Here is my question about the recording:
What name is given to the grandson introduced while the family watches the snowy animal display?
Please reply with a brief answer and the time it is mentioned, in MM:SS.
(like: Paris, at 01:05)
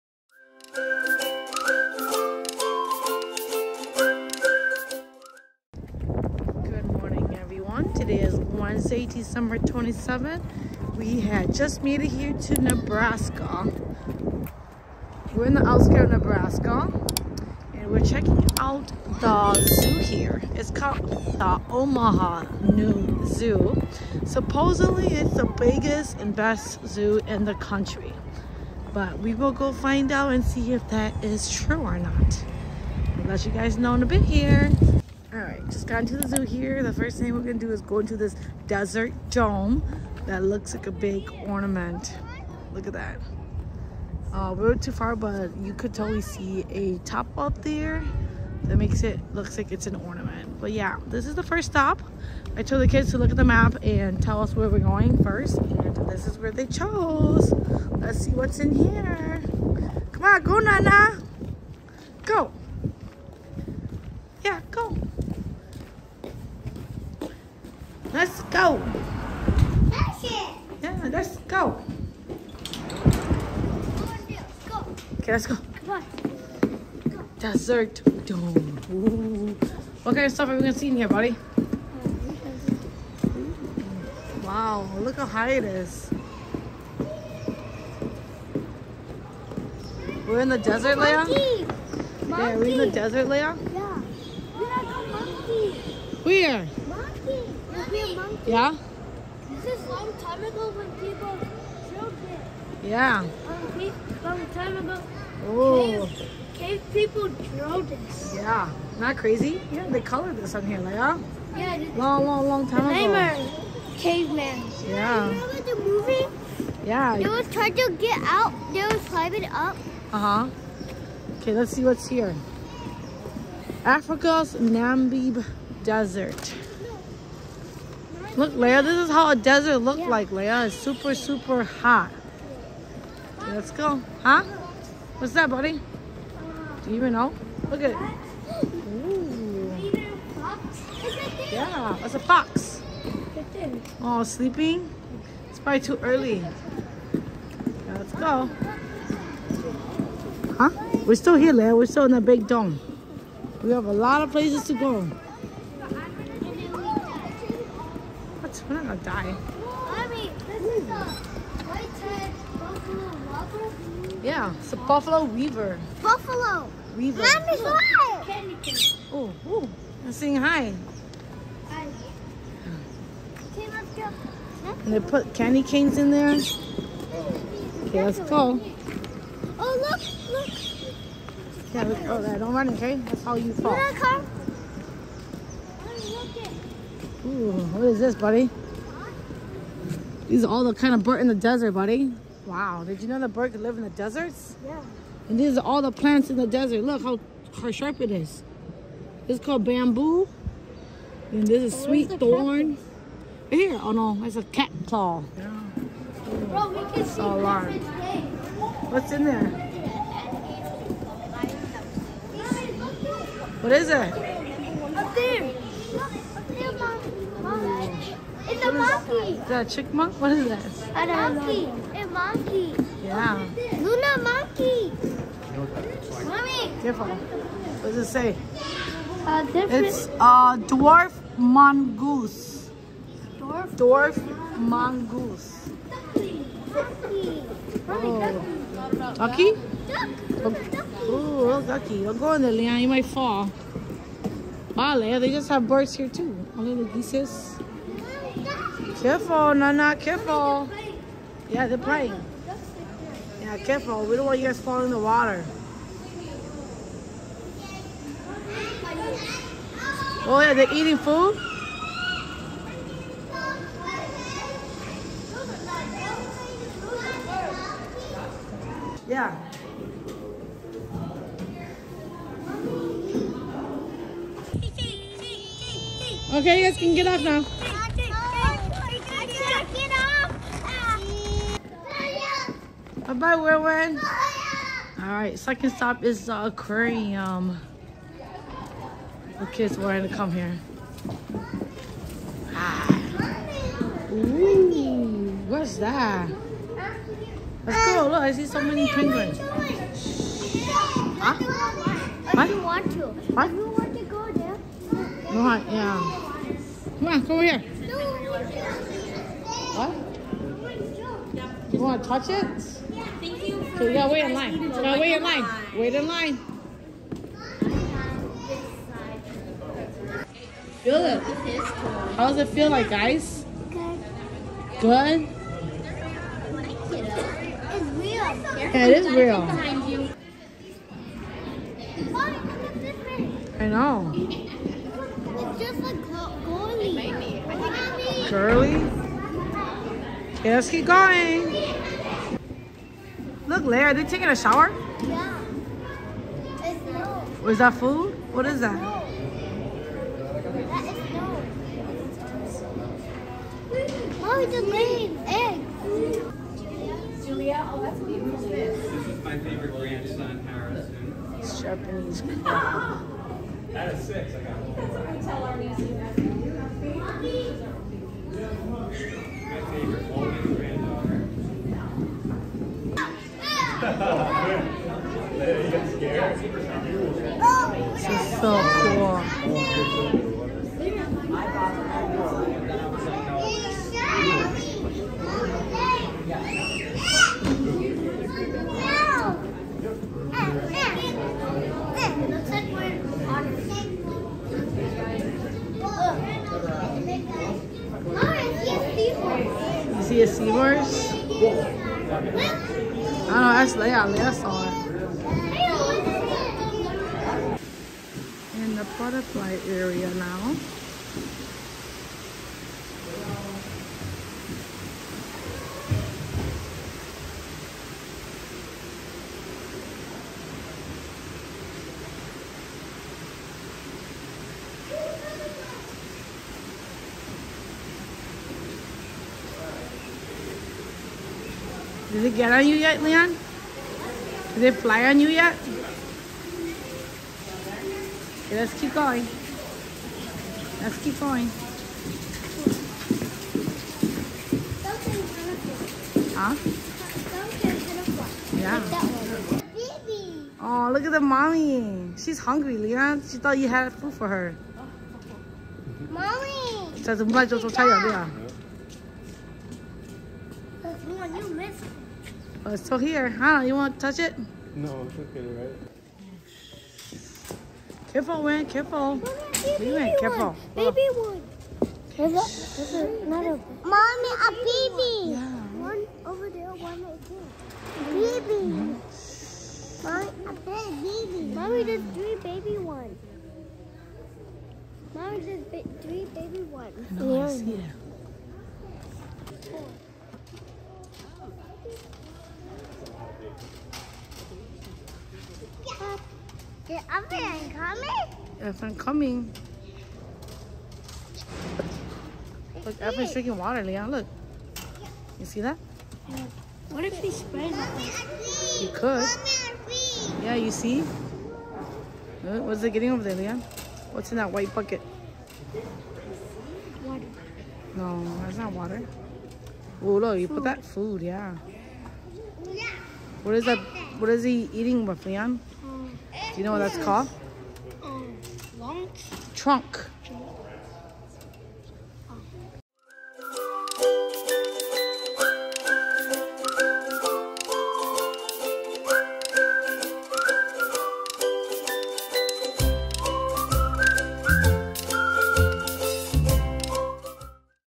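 Harrison, at 06:00.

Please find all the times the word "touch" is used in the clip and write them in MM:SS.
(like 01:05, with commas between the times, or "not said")
05:12, 07:44.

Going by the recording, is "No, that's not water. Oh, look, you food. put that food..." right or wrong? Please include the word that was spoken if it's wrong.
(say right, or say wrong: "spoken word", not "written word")
right.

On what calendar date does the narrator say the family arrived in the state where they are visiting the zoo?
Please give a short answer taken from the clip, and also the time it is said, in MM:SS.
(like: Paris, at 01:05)
December 27th, at 00:09.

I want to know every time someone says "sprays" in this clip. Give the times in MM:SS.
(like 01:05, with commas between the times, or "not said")
08:27.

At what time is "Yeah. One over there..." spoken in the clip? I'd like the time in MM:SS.
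07:55.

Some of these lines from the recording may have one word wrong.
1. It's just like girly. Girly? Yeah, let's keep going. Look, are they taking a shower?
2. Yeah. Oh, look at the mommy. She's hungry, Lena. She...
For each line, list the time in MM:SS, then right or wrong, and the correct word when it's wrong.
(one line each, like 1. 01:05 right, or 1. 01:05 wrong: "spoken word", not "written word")
1. 05:34 right
2. 07:28 right.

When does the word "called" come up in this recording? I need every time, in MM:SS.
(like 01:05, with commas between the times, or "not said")
00:20, 03:19, 08:46.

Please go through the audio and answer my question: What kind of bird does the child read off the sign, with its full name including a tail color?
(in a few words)
White-tailed buffalo weaver.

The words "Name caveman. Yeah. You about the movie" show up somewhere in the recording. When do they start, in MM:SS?
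01:53.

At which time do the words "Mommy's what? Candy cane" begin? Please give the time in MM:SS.
02:47.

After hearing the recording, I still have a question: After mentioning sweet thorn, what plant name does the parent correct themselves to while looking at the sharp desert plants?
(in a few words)
Cat claw.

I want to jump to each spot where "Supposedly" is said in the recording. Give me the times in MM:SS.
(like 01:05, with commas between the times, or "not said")
00:24.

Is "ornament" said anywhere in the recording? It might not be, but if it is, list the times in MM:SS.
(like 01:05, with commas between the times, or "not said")
00:41, 00:49.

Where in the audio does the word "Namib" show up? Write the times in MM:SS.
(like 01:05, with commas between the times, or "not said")
02:04.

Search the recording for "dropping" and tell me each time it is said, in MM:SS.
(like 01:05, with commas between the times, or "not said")
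not said.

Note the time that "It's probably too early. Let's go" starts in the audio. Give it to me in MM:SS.
02:25.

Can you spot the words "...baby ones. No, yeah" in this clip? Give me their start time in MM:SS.
08:06.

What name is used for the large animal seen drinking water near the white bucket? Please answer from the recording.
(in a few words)
Alfred.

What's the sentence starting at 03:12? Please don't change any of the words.
Wow, did you know the bird could live in the deserts?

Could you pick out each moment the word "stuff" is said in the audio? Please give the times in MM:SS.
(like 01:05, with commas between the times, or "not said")
01:20.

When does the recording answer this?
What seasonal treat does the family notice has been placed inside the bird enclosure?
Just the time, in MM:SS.
02:55.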